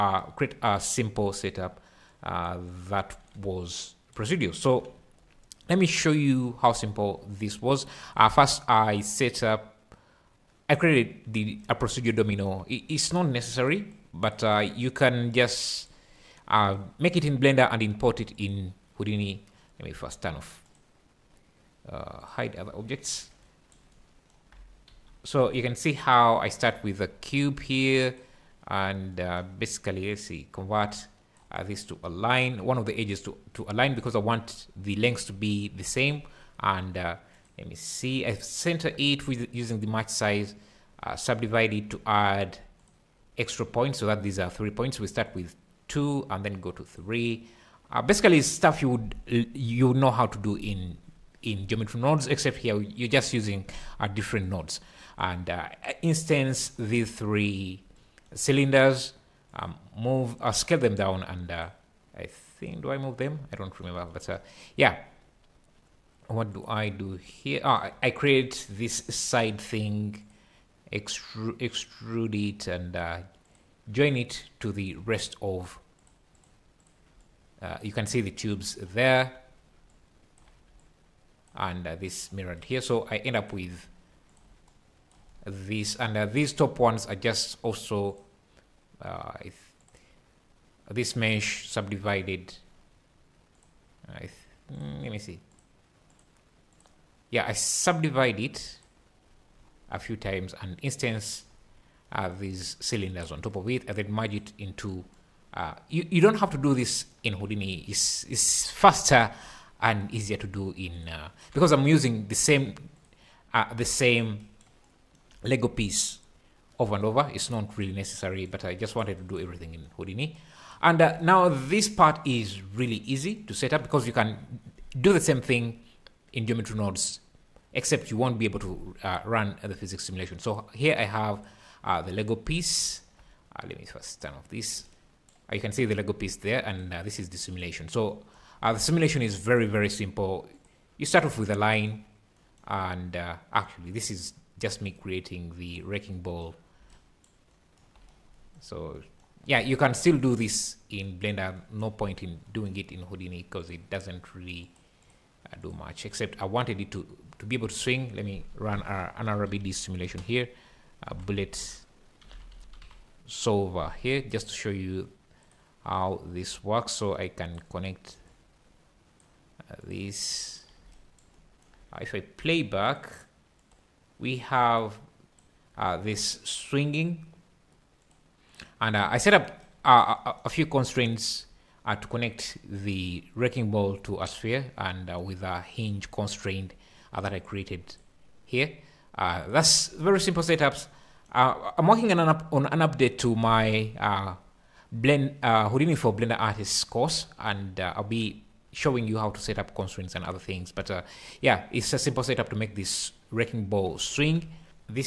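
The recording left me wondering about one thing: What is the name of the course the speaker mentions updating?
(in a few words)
Houdini for Blender Artists.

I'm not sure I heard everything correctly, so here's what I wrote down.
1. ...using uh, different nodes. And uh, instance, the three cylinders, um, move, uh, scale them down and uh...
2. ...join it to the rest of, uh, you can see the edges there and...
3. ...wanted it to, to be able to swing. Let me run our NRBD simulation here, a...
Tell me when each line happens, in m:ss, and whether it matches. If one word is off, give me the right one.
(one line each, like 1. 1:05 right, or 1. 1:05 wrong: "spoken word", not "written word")
1. 0:53 right
2. 1:13 wrong: "tubes", not "edges"
3. 2:36 right.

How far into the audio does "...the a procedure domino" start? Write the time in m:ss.
0:11.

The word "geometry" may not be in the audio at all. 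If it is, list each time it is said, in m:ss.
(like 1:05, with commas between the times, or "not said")
0:51, 2:06.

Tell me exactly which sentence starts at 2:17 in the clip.
So the simulation is very, very simple.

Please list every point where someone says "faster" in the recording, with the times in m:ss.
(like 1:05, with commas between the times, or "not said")
1:48.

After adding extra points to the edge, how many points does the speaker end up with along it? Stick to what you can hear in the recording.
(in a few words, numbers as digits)
3.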